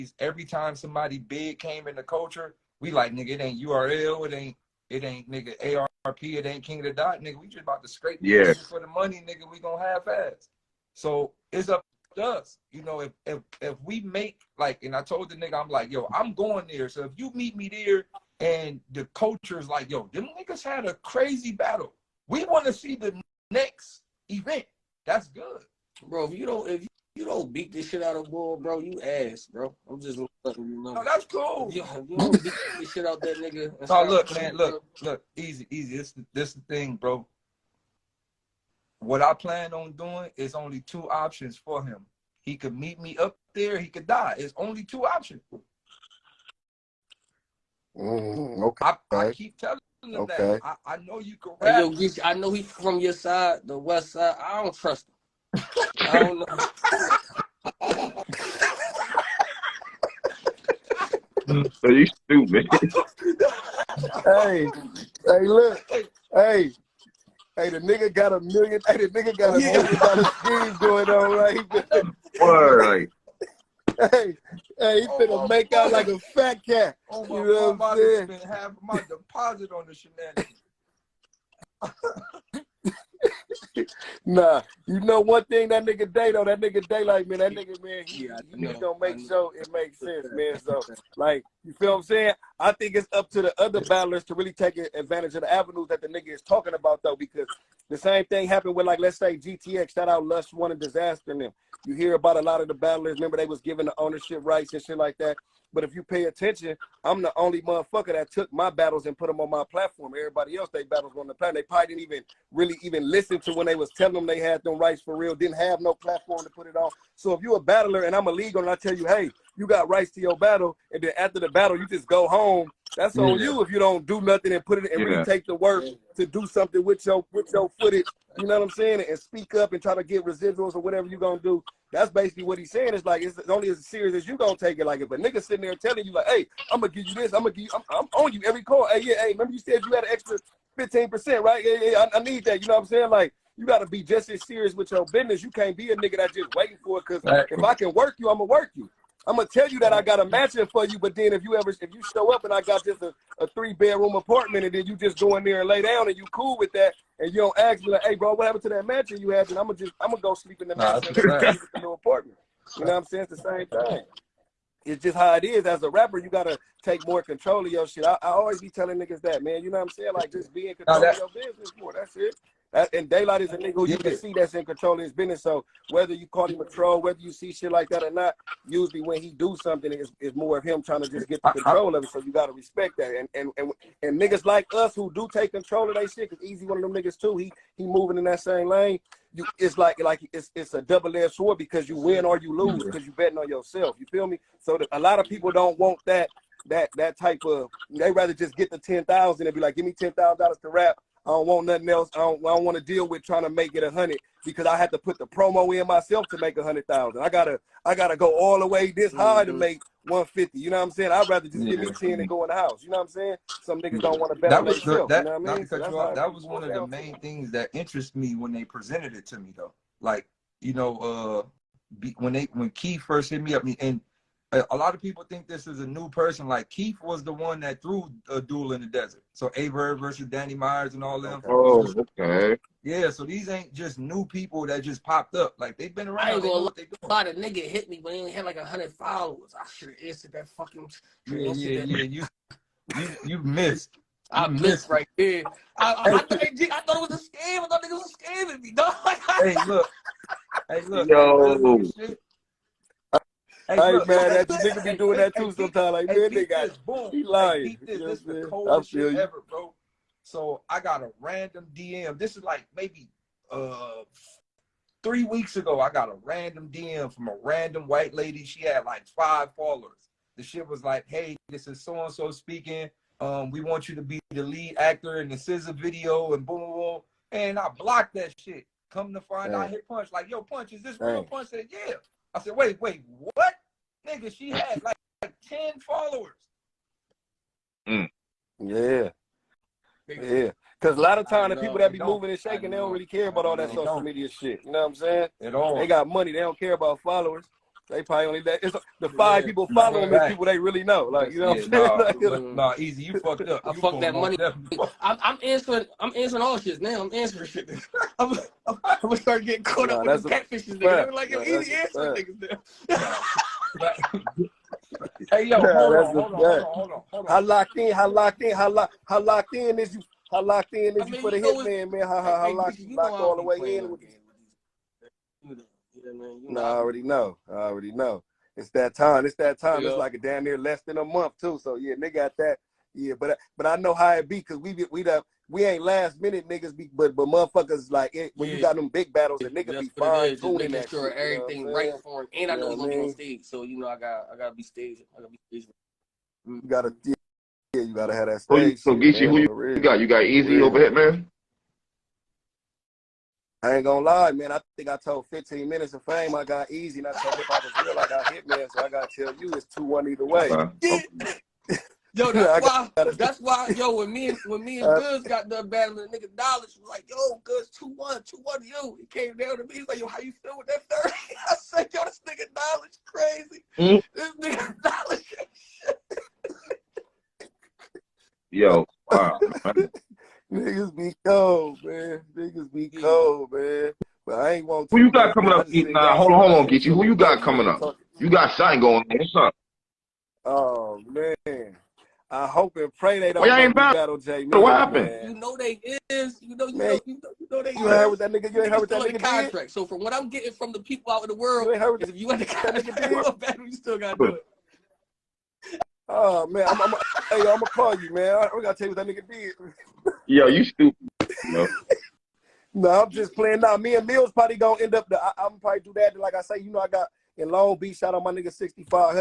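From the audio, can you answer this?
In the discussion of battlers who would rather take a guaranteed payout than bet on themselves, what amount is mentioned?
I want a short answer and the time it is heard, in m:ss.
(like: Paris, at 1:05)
$10,000, at 3:19.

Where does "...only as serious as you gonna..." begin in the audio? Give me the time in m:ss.
2:13.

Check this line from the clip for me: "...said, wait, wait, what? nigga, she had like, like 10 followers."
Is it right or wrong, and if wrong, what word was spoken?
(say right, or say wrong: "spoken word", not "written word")
right.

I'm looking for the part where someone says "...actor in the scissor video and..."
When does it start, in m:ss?
4:34.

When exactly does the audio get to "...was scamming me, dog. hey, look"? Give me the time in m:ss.
4:07.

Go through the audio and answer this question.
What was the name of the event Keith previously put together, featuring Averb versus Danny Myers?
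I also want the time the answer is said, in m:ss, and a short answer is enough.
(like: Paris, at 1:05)
Duel in the Desert, at 3:48.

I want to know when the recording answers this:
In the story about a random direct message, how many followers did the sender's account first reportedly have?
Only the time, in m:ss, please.
4:29.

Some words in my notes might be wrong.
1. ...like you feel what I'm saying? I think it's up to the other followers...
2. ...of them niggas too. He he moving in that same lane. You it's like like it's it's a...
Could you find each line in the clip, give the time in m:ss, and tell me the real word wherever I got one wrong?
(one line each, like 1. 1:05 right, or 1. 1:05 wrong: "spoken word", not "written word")
1. 1:31 wrong: "battlers", not "followers"
2. 3:06 right.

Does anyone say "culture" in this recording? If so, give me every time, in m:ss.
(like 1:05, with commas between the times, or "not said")
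0:02, 0:19.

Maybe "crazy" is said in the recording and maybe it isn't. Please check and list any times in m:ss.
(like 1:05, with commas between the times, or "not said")
0:20, 6:13.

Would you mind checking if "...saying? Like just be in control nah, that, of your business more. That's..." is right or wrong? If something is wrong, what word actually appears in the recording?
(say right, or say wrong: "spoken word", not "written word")
right.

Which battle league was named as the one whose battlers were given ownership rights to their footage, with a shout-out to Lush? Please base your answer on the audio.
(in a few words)
GTX.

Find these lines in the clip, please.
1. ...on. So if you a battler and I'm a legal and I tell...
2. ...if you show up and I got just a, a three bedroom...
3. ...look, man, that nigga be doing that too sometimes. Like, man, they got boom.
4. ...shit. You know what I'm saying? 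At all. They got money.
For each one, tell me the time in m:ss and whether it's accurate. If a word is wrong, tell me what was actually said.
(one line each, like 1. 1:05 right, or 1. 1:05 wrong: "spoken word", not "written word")
1. 1:56 right
2. 2:31 right
3. 4:13 right
4. 4:54 right.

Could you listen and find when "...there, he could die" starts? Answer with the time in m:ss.
0:43.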